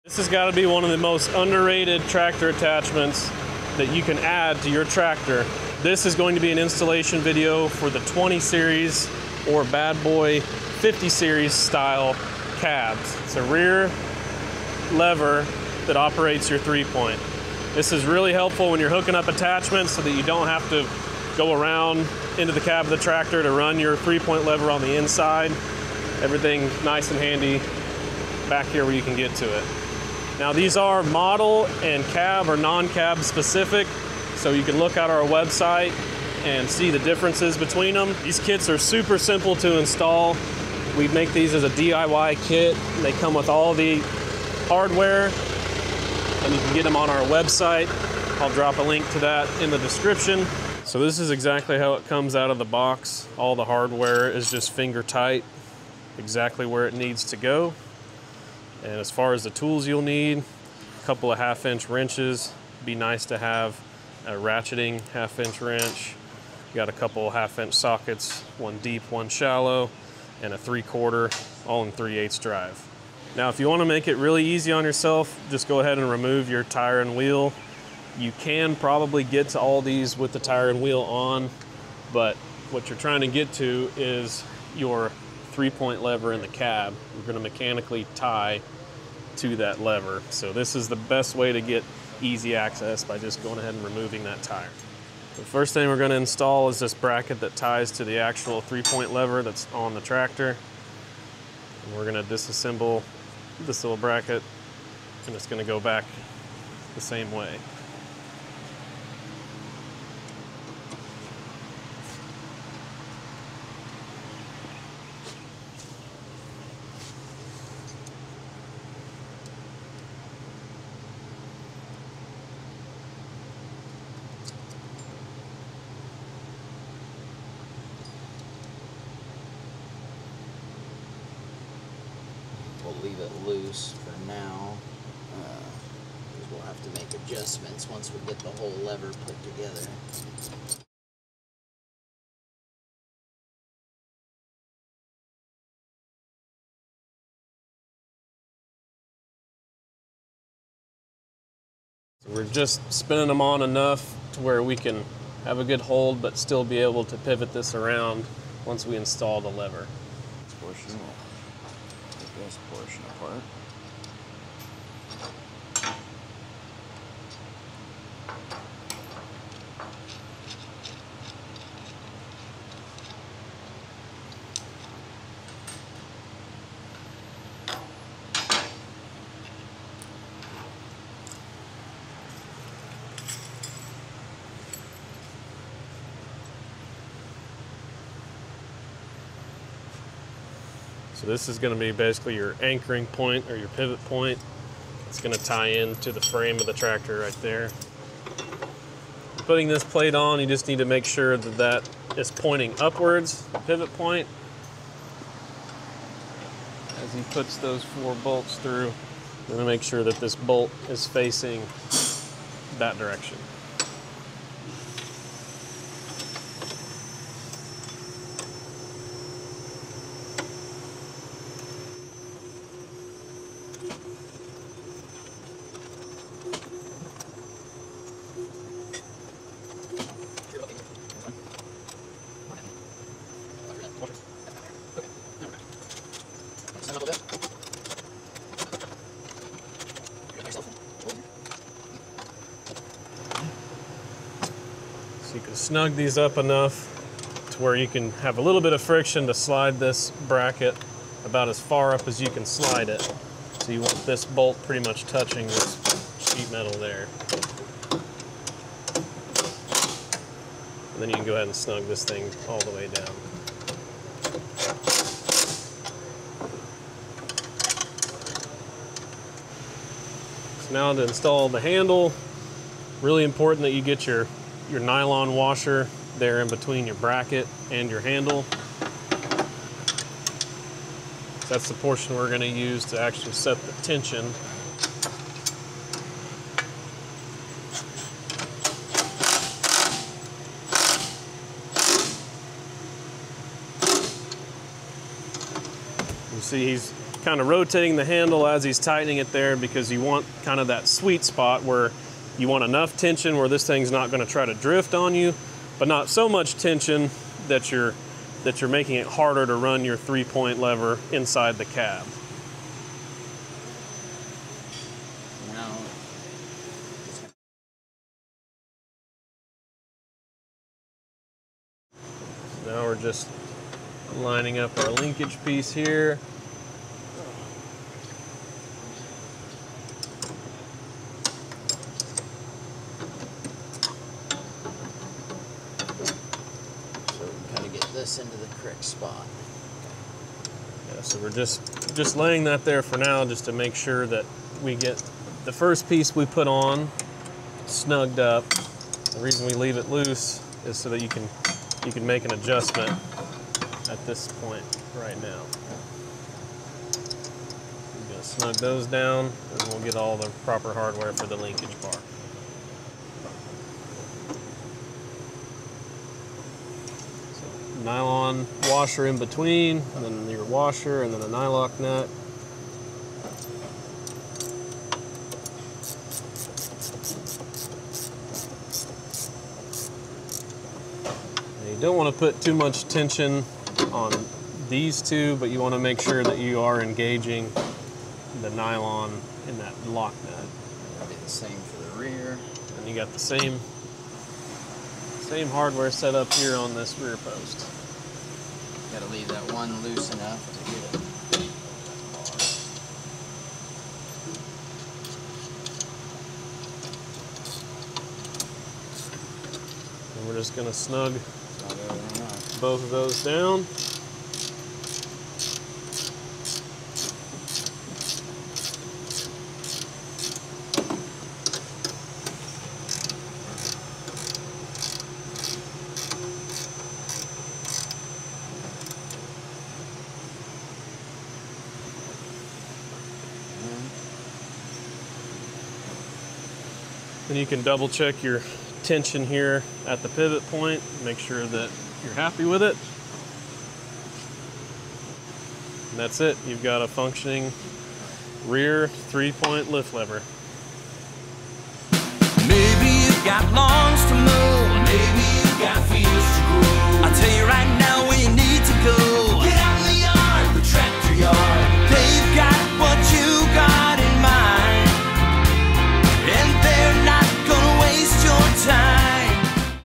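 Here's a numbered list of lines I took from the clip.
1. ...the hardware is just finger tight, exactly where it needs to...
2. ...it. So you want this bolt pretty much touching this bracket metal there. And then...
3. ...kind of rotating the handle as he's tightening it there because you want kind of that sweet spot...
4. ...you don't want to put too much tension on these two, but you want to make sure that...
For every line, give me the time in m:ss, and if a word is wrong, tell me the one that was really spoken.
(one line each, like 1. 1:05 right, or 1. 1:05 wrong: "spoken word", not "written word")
1. 0:53 right
2. 4:12 wrong: "sheet", not "bracket"
3. 4:57 right
4. 6:21 right.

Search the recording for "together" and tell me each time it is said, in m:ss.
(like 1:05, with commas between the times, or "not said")
2:19.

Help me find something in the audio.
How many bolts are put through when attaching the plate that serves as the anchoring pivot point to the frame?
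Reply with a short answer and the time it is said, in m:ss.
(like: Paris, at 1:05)
4, at 3:27.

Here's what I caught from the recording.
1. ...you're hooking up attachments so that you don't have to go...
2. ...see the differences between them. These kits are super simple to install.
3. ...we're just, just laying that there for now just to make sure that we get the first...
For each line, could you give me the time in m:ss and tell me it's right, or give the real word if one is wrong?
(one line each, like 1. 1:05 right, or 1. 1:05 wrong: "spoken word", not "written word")
1. 0:18 right
2. 0:36 right
3. 5:41 right.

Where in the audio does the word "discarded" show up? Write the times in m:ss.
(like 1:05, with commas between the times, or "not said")
not said.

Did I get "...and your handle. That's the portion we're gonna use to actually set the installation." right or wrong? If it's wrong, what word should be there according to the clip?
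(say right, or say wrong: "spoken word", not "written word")
wrong: "tension", not "installation".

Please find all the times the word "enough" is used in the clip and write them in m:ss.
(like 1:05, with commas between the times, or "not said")
2:33, 4:06, 5:02, 6:40.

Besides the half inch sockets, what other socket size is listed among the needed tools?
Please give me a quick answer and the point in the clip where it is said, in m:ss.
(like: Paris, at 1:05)
Three quarter, at 1:10.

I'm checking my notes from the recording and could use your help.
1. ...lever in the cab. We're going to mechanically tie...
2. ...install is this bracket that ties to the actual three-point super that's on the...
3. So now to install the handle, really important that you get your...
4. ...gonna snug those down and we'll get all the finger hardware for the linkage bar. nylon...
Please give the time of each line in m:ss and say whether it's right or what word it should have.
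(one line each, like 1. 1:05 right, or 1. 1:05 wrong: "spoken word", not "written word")
1. 1:26 right
2. 1:36 wrong: "lever", not "super"
3. 4:30 right
4. 5:58 wrong: "proper", not "finger".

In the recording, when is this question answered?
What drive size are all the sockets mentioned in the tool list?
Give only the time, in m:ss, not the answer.
1:11.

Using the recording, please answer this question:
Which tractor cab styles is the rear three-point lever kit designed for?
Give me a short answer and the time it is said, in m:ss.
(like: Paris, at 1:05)
20 series or 50 series, at 0:08.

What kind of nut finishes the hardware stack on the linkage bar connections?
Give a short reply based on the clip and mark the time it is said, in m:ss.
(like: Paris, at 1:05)
Nylock nut, at 6:11.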